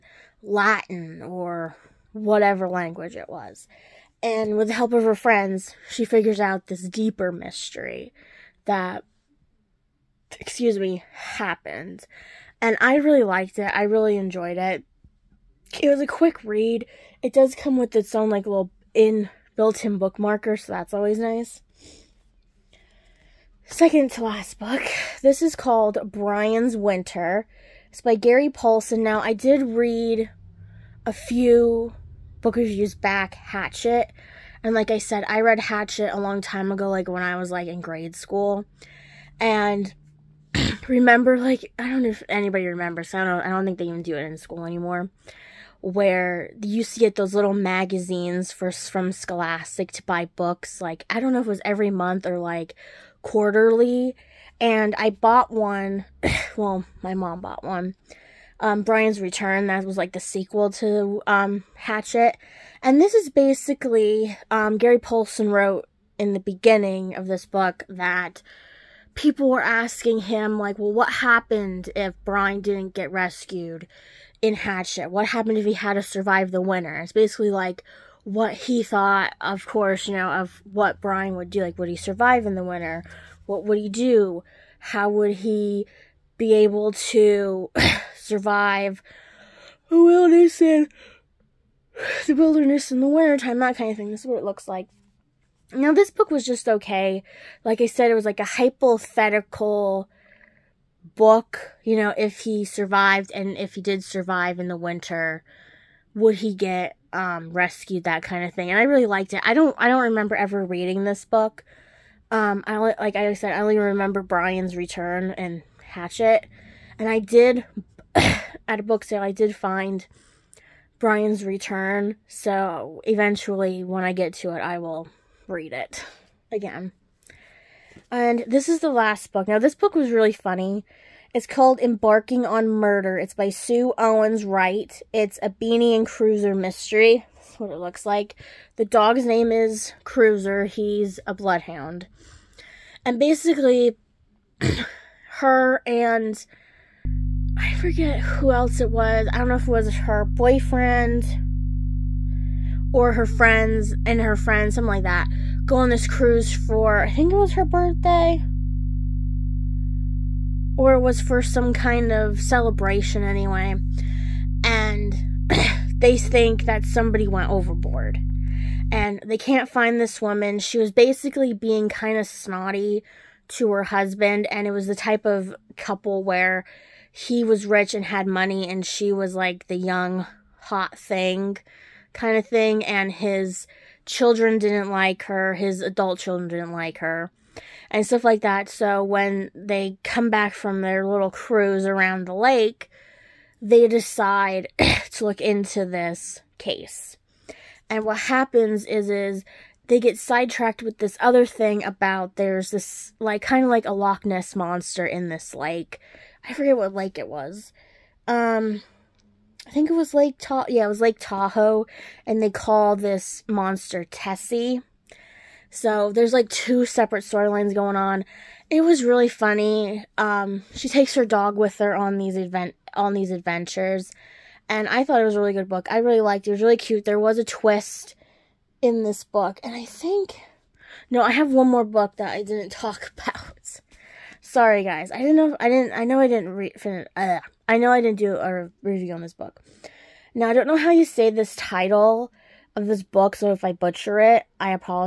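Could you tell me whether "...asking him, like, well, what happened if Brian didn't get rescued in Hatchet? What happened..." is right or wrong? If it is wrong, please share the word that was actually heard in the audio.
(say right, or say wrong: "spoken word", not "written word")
right.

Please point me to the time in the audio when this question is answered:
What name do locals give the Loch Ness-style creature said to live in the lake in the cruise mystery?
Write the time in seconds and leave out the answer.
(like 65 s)
214 s.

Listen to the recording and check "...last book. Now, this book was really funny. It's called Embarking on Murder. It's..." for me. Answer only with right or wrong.
right.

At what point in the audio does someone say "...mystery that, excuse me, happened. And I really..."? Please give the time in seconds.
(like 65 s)
7 s.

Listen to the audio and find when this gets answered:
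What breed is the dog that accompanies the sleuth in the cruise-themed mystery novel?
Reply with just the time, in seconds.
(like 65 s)
141 s.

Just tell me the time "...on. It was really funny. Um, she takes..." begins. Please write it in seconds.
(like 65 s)
217 s.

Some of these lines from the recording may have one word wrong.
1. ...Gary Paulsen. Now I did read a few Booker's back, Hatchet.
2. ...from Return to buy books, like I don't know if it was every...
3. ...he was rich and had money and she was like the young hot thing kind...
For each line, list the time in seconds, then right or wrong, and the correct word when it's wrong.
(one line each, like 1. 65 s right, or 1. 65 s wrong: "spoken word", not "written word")
1. 28 s right
2. 48 s wrong: "Scholastic", not "Return"
3. 177 s right.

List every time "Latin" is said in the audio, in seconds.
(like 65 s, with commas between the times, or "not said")
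0 s.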